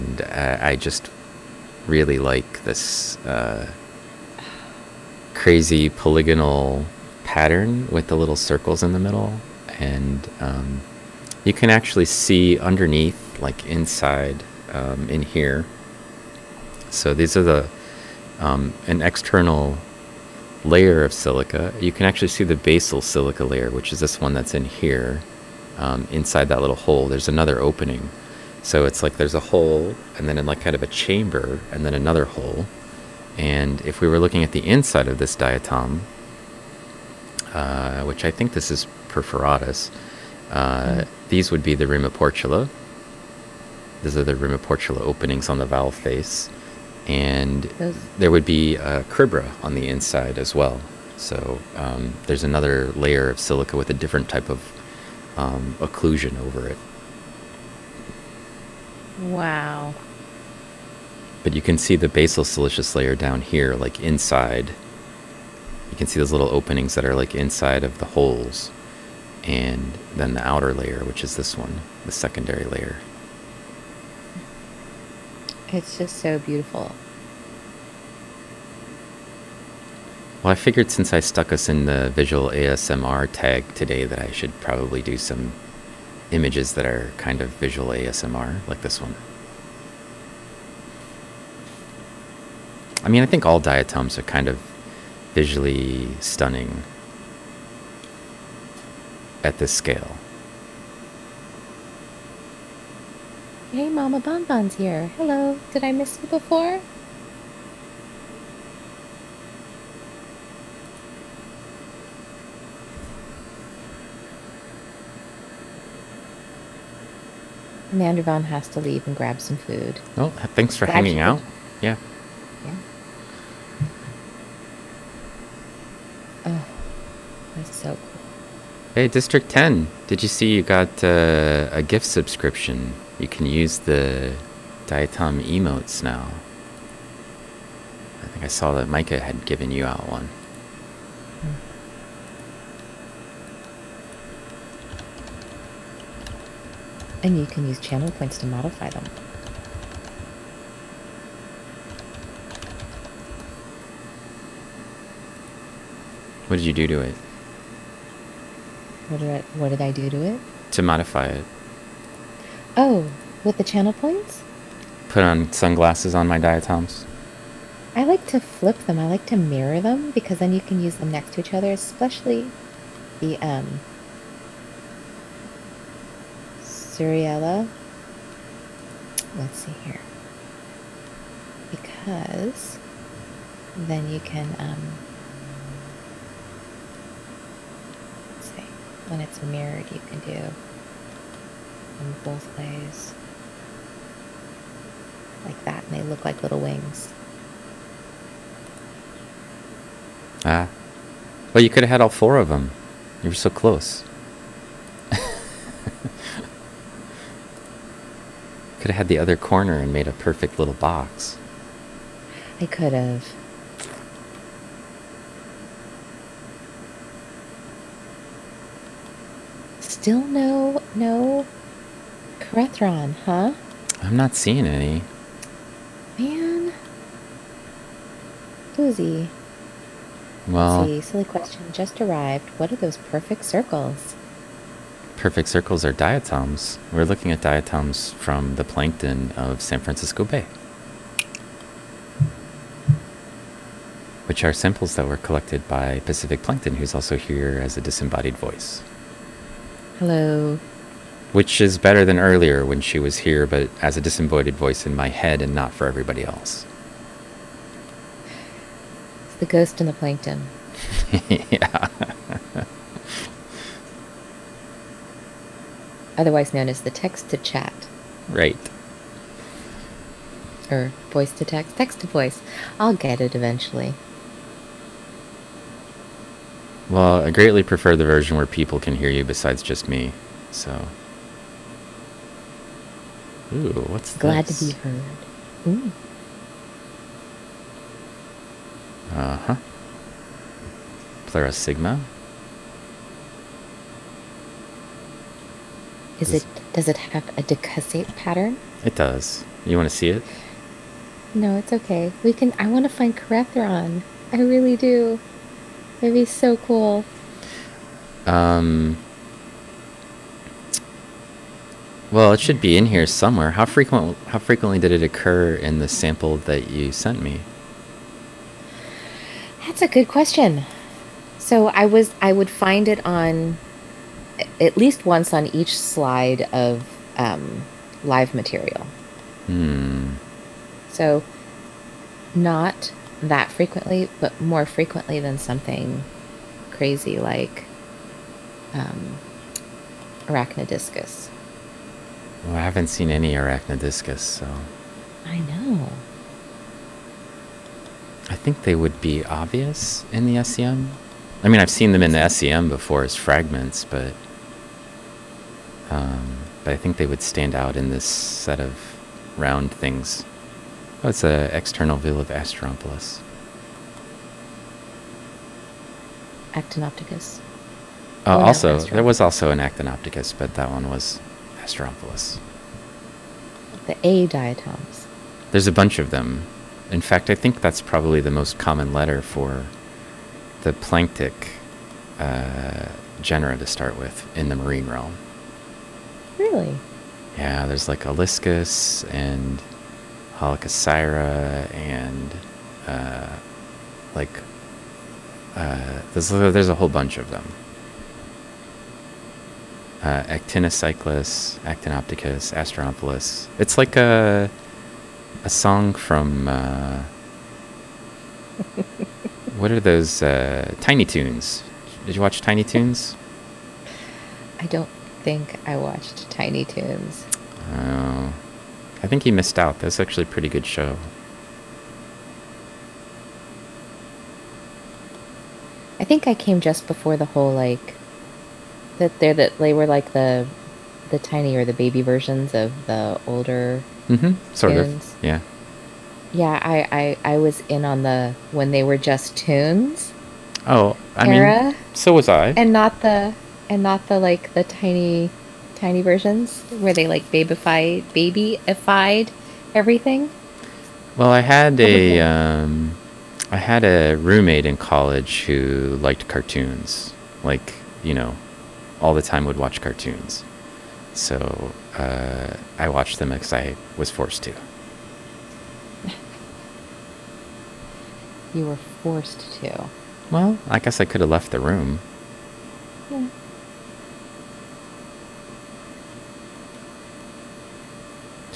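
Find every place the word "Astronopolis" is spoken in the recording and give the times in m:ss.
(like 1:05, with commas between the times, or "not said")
6:42.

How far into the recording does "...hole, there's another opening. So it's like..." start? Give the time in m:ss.
0:26.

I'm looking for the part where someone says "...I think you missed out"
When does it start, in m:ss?
6:59.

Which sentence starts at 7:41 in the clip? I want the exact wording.
So uh, I watched them because I was forced to.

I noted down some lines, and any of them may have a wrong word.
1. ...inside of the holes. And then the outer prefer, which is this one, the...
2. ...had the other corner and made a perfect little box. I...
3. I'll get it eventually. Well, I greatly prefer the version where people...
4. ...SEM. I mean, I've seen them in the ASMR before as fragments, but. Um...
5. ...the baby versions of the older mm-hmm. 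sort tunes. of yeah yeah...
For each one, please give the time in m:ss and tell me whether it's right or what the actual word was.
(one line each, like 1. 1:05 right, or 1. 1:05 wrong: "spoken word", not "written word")
1. 1:07 wrong: "layer", not "prefer"
2. 3:28 right
3. 4:32 right
4. 5:50 wrong: "SEM", not "ASMR"
5. 7:11 right.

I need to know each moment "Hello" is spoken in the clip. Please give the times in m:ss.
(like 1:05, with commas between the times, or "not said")
1:45, 4:09.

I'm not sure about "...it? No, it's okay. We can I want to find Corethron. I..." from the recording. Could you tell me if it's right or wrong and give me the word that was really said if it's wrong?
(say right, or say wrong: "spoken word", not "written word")
right.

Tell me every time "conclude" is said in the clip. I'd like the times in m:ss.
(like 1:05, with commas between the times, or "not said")
not said.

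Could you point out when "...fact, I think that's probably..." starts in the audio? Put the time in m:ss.
6:17.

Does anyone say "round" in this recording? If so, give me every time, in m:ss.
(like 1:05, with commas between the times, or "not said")
5:59.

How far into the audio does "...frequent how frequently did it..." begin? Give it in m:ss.
5:13.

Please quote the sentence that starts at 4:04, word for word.
Which are samples that were collected by Pacific Plankton, who's also here as a disembodied voice.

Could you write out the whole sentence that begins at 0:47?
And there would be a cribra on the inside as well.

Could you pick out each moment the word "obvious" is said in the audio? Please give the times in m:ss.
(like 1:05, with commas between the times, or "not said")
5:49.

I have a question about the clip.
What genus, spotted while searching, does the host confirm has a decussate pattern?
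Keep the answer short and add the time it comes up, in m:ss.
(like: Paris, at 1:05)
Pleurosigma, at 4:51.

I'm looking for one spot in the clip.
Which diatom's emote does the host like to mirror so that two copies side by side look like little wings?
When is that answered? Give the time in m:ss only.
2:56.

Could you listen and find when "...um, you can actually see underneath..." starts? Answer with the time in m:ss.
0:10.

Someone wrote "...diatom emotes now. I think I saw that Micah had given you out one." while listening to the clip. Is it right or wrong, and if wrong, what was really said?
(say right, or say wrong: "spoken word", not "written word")
right.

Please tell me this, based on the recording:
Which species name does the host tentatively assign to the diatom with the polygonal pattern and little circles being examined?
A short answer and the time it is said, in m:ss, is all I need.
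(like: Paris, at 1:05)
perforatus, at 0:39.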